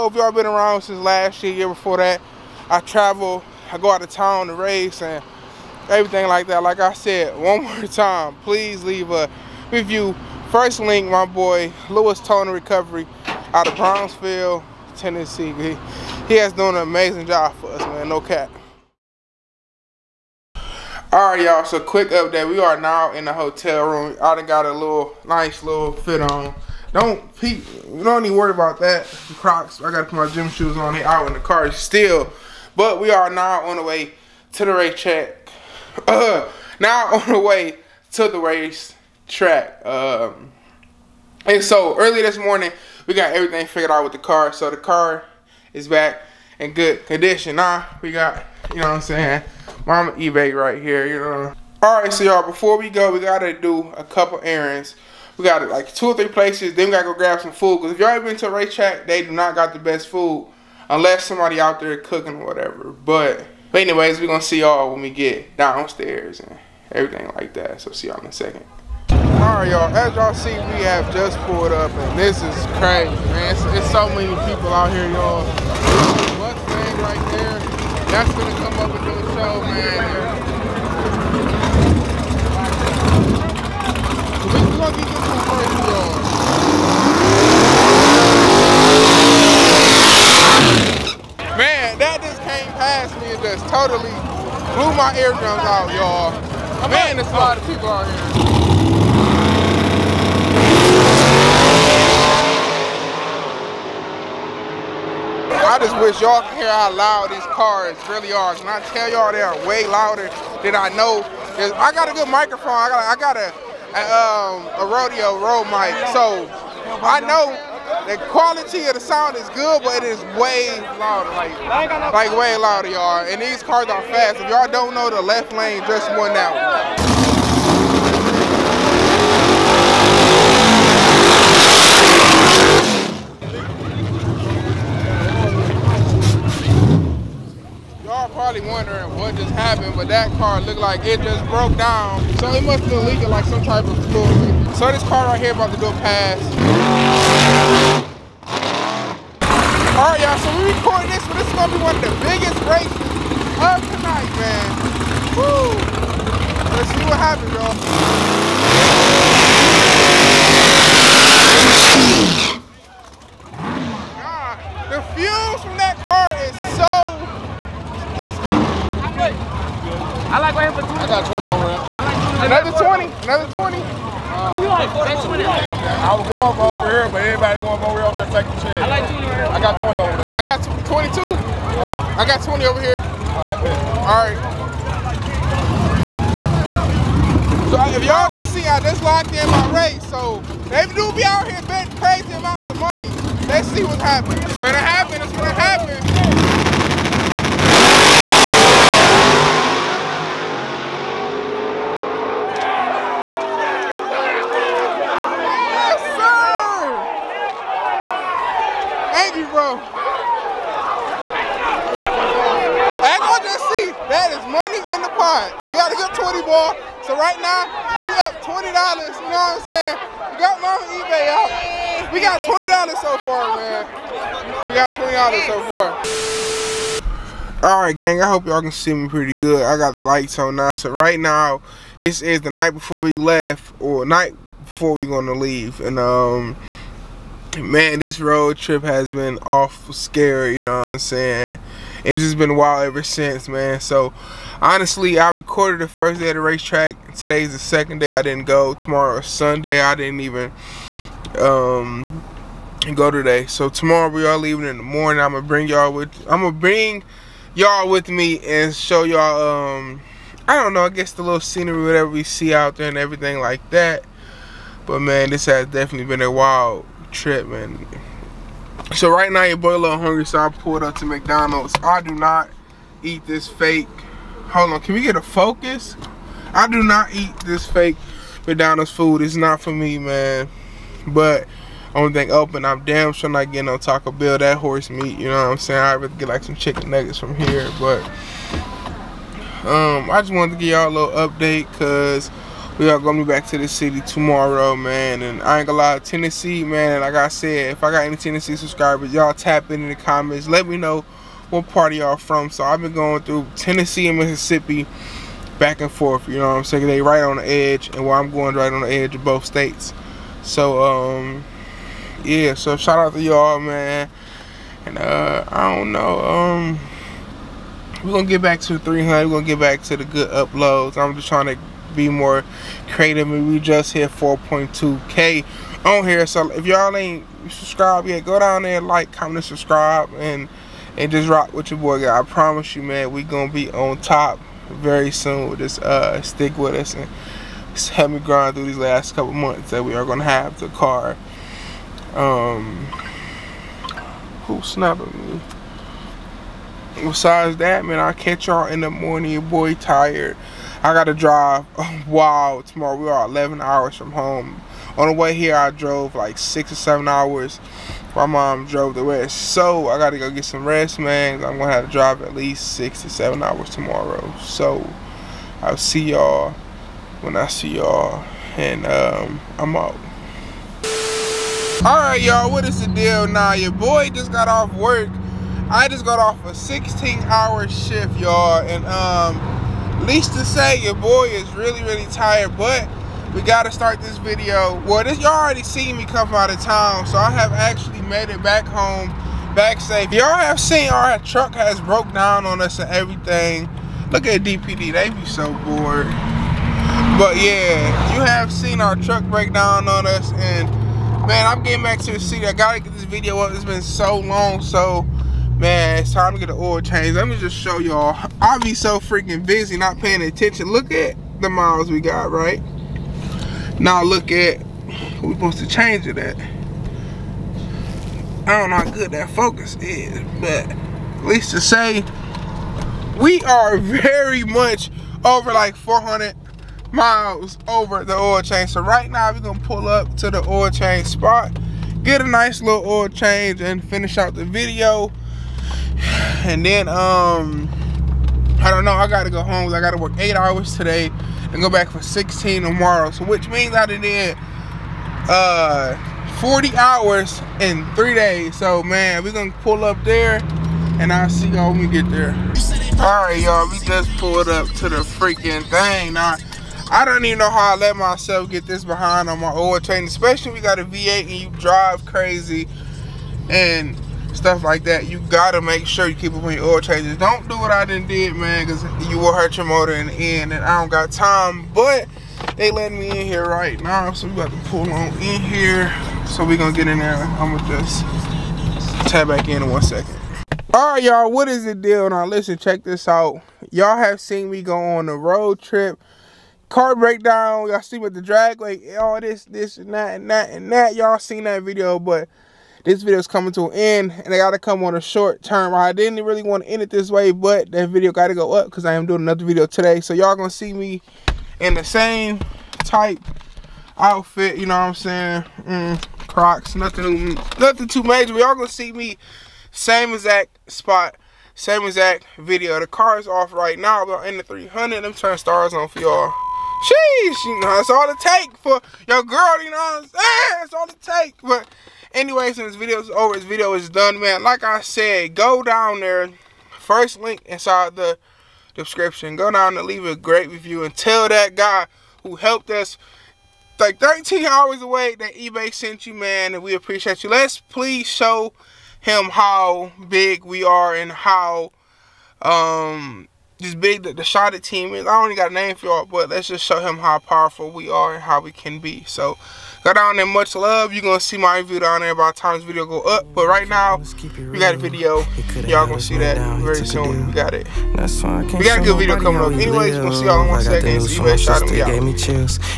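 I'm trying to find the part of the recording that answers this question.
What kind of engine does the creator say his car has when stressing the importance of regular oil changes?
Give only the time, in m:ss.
7:40.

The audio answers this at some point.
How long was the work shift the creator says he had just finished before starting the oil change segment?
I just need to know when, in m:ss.
6:16.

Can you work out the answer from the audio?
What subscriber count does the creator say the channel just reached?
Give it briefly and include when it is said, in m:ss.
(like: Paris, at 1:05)
4.2k, at 5:24.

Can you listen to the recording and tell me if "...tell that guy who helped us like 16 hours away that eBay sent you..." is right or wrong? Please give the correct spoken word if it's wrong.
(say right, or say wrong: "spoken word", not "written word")
wrong: "13", not "16".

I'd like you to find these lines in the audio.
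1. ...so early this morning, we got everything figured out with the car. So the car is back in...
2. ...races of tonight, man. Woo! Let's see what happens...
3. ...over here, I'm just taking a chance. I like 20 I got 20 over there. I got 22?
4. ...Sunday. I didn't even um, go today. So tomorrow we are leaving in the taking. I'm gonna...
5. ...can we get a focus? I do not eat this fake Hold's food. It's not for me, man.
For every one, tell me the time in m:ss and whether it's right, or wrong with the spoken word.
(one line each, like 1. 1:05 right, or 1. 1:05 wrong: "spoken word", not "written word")
1. 0:41 right
2. 2:32 right
3. 2:57 right
4. 4:09 wrong: "morning", not "taking"
5. 4:34 wrong: "McDonald", not "Hold".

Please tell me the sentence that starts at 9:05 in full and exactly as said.
I only got a name for y'all, but let's just show him how powerful we are and how we can be.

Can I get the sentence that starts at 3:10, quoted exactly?
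So they do be out here betting crazy amounts of money.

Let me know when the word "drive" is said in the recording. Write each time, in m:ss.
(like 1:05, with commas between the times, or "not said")
5:51, 6:01, 7:41.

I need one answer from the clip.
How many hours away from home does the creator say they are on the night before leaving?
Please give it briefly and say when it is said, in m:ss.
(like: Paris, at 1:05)
11, at 5:53.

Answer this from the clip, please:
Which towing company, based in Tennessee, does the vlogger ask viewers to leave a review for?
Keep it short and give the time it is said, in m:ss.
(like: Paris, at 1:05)
Lewis Towing and Recovery, at 0:11.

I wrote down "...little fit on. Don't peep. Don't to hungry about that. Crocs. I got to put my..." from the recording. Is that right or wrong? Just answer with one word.
wrong.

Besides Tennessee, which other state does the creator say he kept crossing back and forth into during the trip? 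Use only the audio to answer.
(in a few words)
Mississippi.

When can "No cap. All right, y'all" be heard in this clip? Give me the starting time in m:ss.
0:18.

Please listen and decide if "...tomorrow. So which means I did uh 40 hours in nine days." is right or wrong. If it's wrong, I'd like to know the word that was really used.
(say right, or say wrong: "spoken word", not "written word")
wrong: "three", not "nine".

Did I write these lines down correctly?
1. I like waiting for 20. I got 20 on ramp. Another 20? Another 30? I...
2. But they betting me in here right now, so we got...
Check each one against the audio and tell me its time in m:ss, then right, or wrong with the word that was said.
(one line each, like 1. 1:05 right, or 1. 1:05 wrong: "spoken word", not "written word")
1. 2:50 wrong: "20", not "30"
2. 7:51 wrong: "letting", not "betting".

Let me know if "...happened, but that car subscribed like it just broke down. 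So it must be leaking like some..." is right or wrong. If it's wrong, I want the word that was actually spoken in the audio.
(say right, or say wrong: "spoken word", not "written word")
wrong: "looked", not "subscribed".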